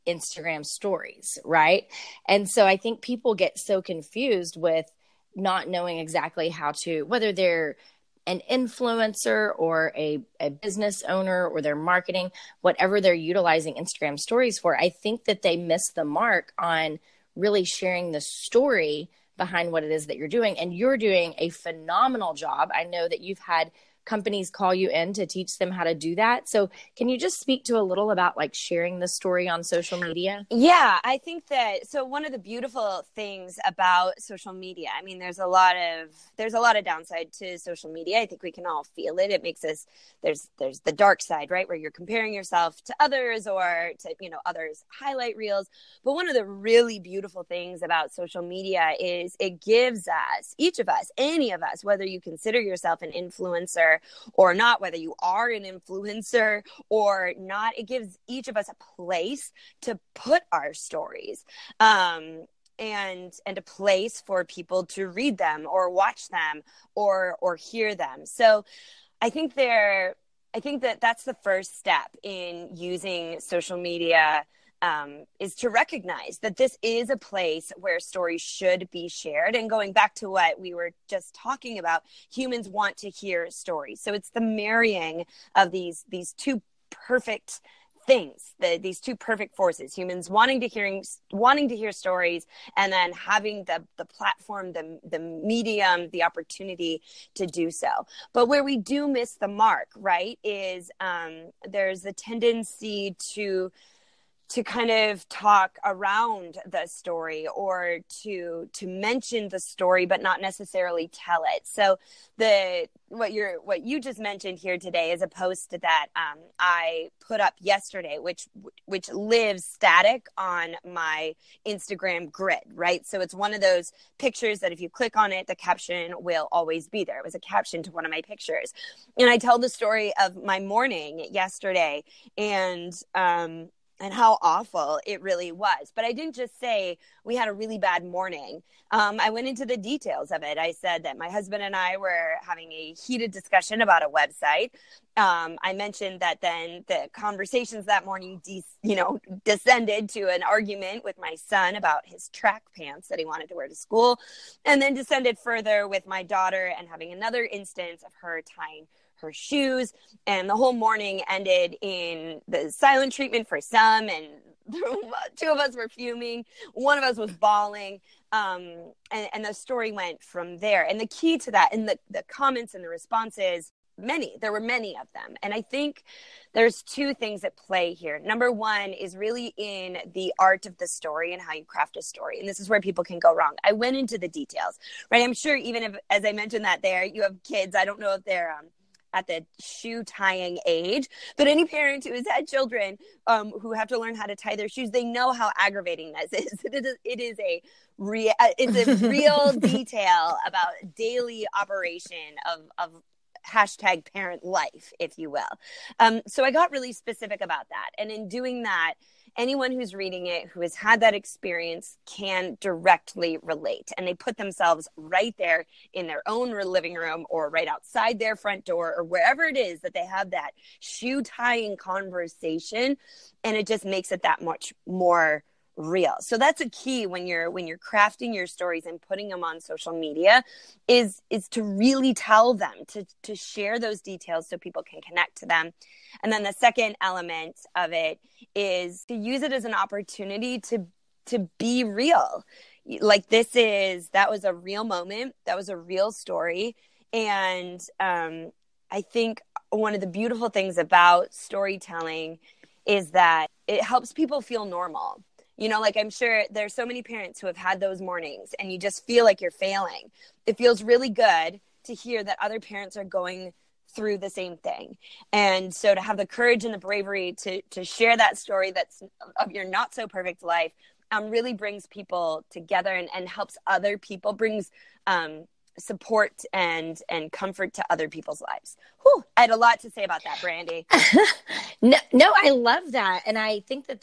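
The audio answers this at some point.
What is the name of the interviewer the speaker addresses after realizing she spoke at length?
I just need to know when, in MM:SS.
04:40.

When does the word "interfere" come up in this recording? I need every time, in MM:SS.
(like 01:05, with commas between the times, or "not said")
not said.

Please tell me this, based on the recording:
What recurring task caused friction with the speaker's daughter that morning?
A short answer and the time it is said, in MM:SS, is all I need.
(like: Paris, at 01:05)
Tying her shoes, at 02:38.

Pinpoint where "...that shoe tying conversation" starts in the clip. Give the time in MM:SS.
03:40.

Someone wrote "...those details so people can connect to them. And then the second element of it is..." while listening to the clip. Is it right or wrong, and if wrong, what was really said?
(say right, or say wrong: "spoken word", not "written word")
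right.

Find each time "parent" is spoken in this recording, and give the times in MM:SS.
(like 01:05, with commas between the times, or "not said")
03:11, 03:24, 04:17, 04:22.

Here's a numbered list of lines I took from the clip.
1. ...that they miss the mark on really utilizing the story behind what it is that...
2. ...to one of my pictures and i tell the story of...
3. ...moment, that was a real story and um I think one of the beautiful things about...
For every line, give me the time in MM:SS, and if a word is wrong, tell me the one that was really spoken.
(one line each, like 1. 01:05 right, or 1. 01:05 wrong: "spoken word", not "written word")
1. 00:15 wrong: "sharing", not "utilizing"
2. 02:07 right
3. 04:04 right.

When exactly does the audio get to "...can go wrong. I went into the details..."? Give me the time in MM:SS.
03:03.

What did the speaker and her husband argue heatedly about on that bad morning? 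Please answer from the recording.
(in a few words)
A website.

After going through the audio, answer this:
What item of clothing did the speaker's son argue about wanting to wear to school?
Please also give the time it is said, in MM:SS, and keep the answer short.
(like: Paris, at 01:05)
Track pants, at 02:32.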